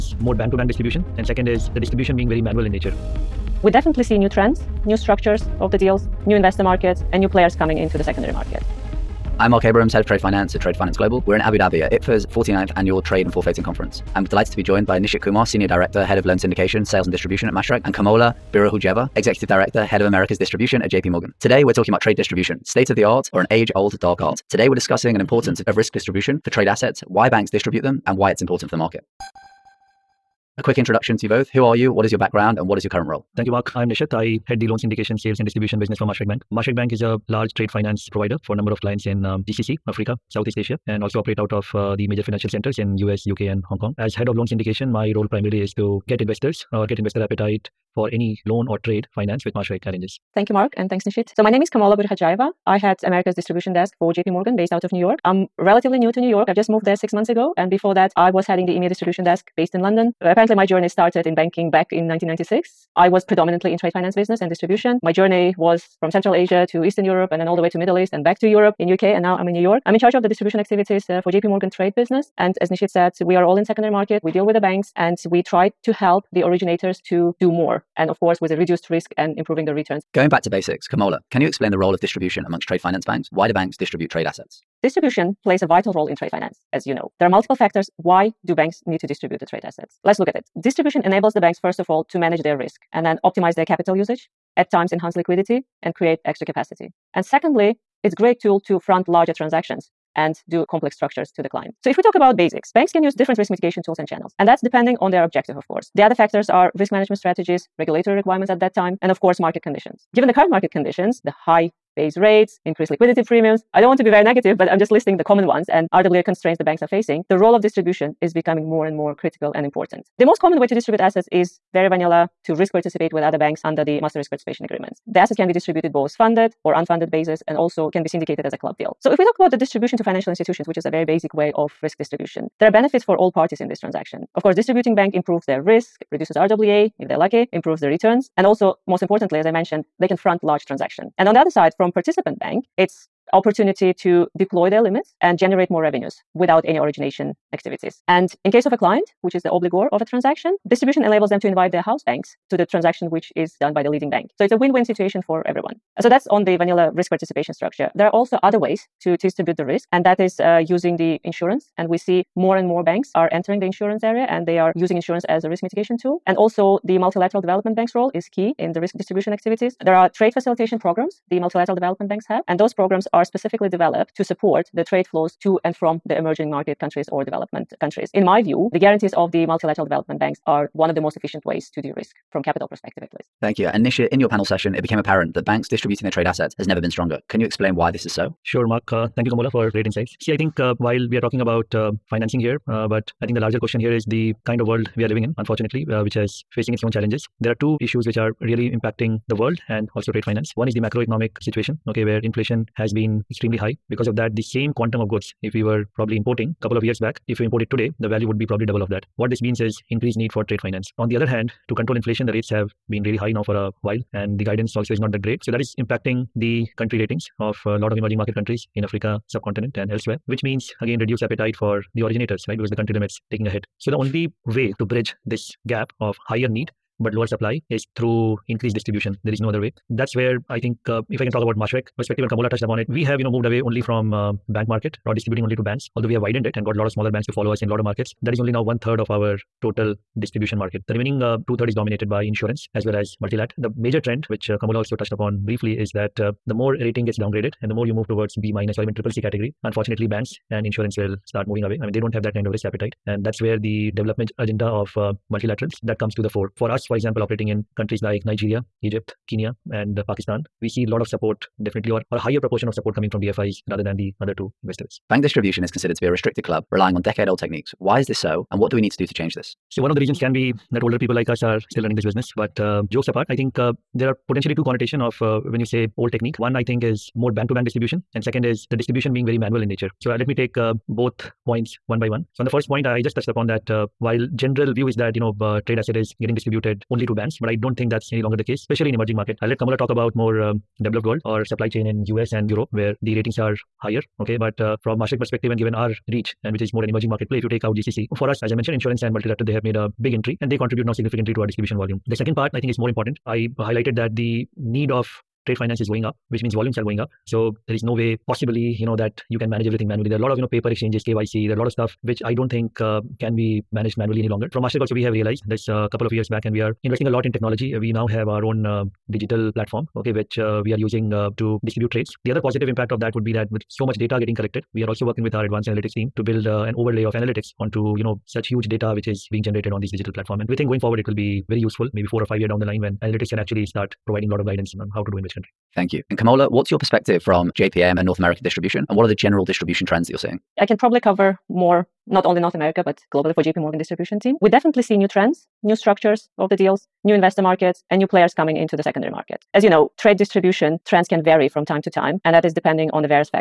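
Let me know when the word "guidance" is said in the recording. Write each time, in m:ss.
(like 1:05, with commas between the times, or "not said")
3:34, 5:34.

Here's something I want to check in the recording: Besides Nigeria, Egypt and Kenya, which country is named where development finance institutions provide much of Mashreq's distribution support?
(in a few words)
Pakistan.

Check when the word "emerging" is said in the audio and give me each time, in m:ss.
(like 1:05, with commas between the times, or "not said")
2:56, 3:37, 4:48, 4:56.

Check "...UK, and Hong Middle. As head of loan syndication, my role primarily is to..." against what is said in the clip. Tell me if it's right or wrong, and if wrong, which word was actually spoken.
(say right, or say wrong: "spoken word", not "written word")
wrong: "Kong", not "Middle".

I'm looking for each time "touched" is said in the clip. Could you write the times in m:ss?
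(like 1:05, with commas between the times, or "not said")
3:52, 4:04, 4:43.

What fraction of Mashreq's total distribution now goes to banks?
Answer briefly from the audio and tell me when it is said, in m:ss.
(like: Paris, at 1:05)
One third, at 3:58.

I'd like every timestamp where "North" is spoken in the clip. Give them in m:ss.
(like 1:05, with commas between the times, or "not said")
5:38, 5:42.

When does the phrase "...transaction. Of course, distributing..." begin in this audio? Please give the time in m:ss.
2:13.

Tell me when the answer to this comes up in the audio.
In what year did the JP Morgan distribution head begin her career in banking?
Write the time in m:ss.
1:02.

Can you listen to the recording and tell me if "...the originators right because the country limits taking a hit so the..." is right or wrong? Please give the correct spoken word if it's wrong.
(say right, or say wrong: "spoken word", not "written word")
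right.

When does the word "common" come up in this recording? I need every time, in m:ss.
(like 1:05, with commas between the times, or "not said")
1:55, 2:00.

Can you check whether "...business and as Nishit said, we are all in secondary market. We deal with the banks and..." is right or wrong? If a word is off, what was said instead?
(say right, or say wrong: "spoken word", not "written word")
right.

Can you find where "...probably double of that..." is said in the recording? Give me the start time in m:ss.
3:28.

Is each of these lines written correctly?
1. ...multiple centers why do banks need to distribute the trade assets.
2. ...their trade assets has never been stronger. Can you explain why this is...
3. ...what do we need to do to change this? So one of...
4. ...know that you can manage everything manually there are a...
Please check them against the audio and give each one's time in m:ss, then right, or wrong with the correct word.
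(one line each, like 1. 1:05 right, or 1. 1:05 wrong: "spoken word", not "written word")
1. 1:27 wrong: "factors", not "centers"
2. 3:06 right
3. 4:28 right
4. 5:08 right.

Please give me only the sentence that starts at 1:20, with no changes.
Going back to basics, Kamola, can you explain the role of distribution amongst trade finance banks?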